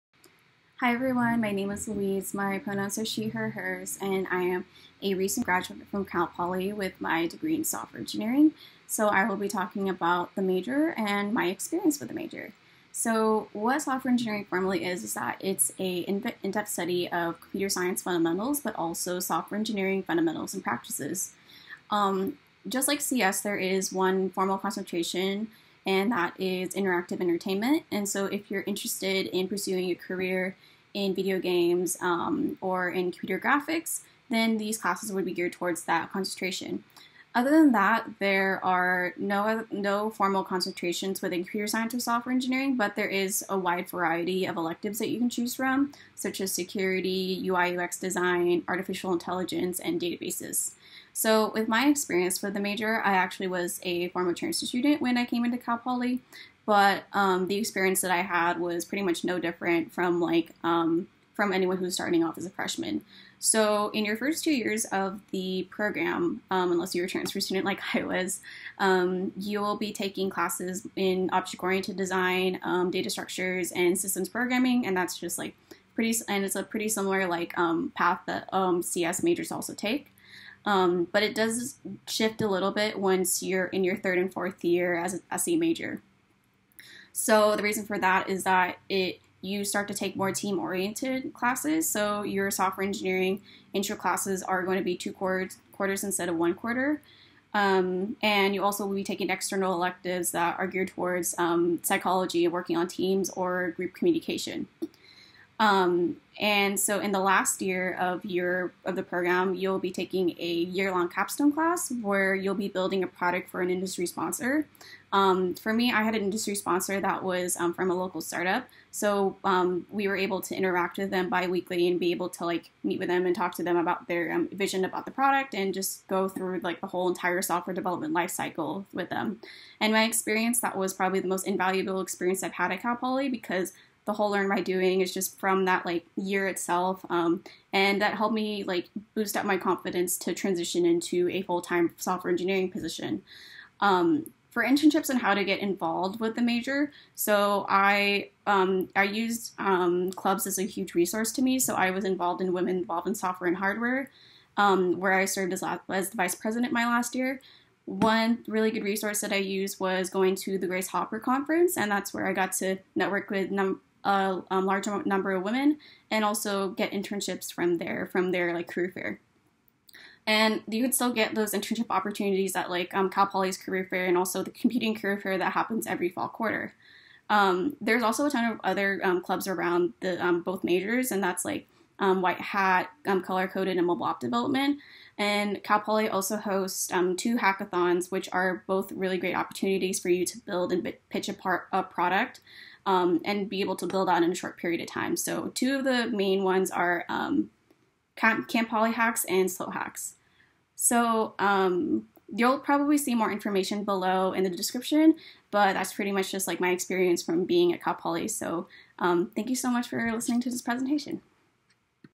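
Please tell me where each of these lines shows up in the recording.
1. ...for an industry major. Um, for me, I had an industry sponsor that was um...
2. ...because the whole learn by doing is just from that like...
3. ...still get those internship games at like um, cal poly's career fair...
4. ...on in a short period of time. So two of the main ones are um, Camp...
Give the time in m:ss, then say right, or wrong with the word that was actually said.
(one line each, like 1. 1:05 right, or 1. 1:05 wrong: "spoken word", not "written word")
1. 1:53 wrong: "sponsor", not "major"
2. 2:13 right
3. 2:50 wrong: "opportunities", not "games"
4. 3:14 right.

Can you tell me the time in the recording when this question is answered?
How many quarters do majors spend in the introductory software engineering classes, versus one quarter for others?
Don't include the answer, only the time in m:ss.
1:34.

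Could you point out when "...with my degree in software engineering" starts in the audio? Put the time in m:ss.
0:06.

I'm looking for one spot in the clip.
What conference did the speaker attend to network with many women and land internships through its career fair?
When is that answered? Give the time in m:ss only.
2:40.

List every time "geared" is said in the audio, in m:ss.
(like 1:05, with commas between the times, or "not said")
0:35, 1:40.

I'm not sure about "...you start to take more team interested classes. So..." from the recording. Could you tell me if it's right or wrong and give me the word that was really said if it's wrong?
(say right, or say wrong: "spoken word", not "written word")
wrong: "oriented", not "interested".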